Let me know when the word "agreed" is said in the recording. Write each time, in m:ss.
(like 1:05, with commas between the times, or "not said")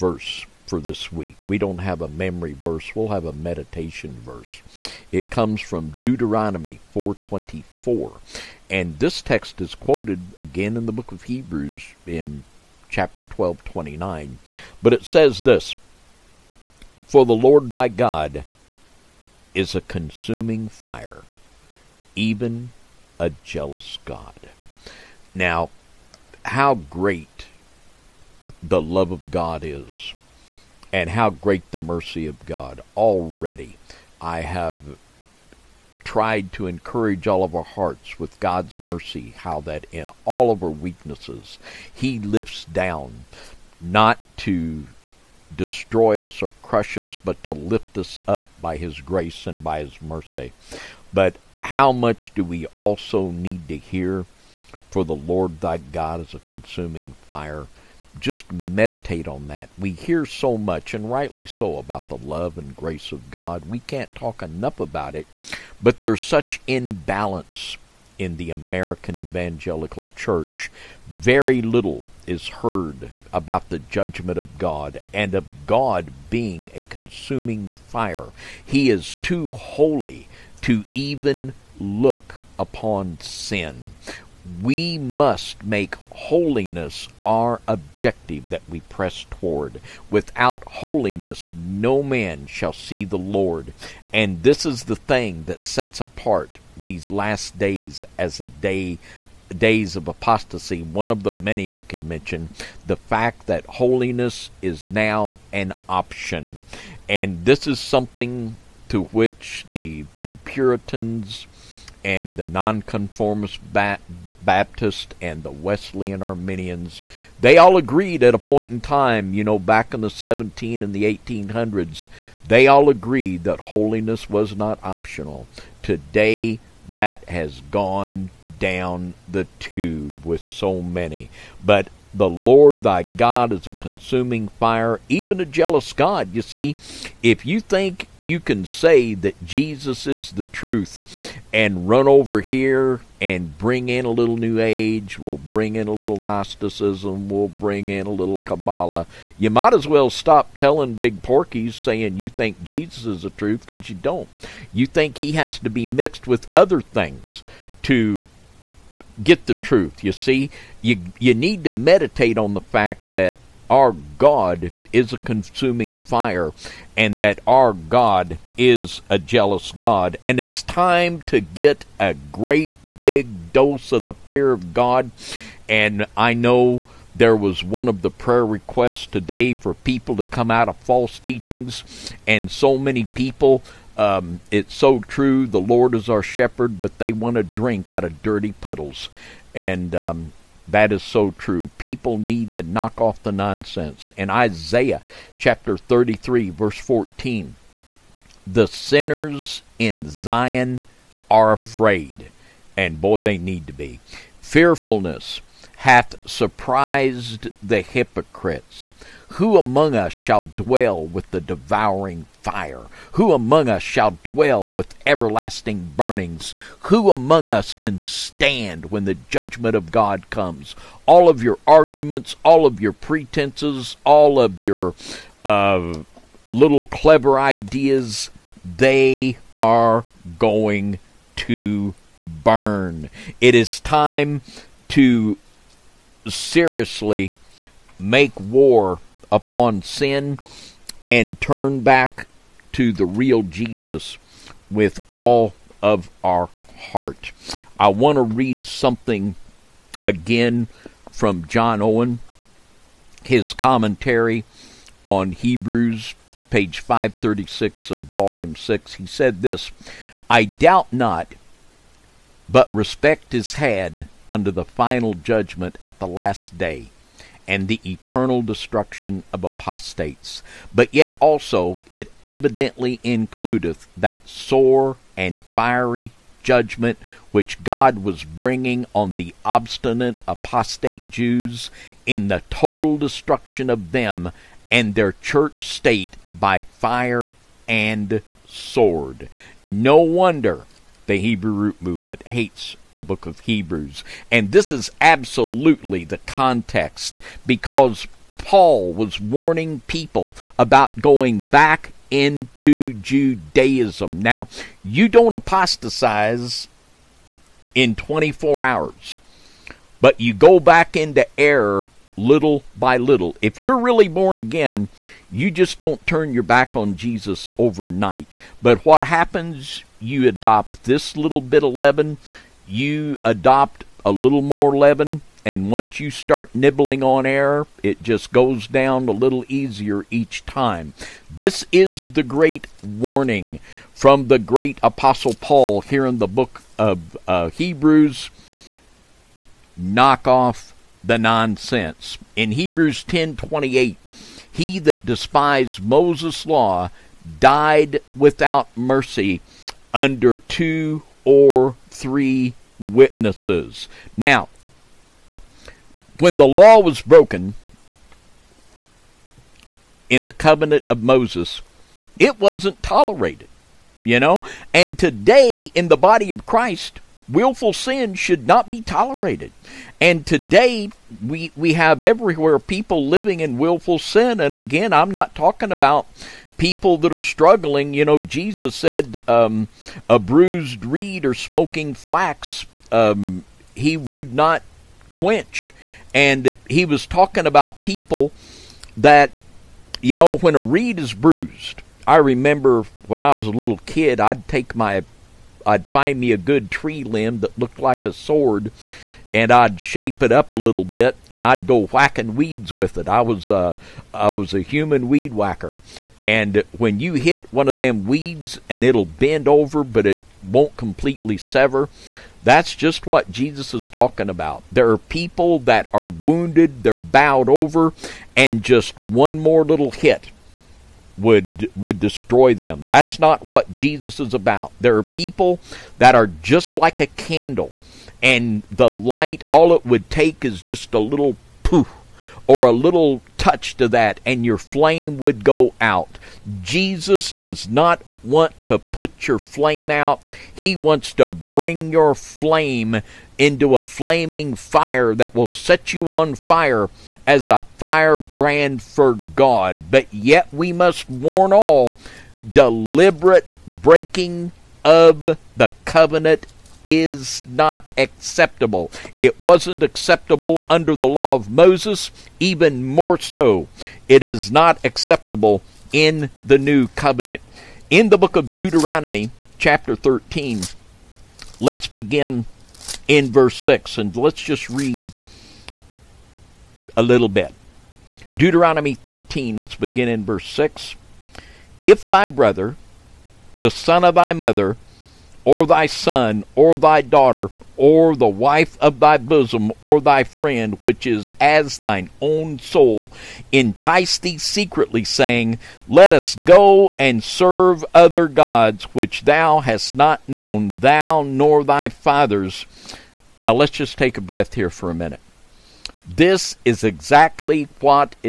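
1:57, 2:02.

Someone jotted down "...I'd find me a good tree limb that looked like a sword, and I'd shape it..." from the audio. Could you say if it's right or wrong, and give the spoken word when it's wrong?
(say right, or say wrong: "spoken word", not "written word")
right.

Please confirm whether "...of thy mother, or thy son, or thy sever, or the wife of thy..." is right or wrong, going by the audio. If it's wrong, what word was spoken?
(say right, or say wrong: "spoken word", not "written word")
wrong: "daughter", not "sever".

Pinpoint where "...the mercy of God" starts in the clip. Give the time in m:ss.
0:31.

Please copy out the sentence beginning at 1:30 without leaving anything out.
Without holiness, no man shall see the Lord.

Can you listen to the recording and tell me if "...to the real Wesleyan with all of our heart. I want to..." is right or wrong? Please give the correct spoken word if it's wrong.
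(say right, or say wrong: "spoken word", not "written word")
wrong: "Jesus", not "Wesleyan".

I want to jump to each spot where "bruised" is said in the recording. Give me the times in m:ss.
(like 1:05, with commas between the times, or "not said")
6:20, 6:31.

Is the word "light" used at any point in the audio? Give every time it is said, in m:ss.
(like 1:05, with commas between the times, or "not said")
7:08.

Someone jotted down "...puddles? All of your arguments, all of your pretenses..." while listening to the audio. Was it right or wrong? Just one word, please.
wrong.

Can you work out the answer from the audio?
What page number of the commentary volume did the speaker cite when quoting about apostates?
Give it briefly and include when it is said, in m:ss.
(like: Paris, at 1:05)
536, at 4:16.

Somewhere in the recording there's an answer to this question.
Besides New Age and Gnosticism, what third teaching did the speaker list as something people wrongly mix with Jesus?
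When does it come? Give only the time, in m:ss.
2:28.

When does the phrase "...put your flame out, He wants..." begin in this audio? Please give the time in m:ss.
7:18.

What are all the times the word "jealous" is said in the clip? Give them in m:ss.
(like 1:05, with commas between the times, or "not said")
0:23, 2:15, 2:49.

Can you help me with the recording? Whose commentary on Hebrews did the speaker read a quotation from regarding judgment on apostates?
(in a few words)
John Owen.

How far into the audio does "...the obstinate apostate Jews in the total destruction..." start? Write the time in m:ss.
4:39.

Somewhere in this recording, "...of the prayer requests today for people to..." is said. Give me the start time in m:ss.
2:57.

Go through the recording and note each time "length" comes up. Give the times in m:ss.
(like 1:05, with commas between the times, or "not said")
not said.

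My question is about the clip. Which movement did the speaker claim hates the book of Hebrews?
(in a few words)
Hebrew root movement.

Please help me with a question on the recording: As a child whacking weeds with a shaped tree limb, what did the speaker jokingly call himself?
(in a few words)
human weed whacker.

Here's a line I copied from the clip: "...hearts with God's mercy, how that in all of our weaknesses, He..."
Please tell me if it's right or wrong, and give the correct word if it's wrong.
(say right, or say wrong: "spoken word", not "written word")
right.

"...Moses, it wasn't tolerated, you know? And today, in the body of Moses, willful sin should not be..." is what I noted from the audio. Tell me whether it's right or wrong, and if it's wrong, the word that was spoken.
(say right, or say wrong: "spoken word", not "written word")
wrong: "Christ", not "Moses".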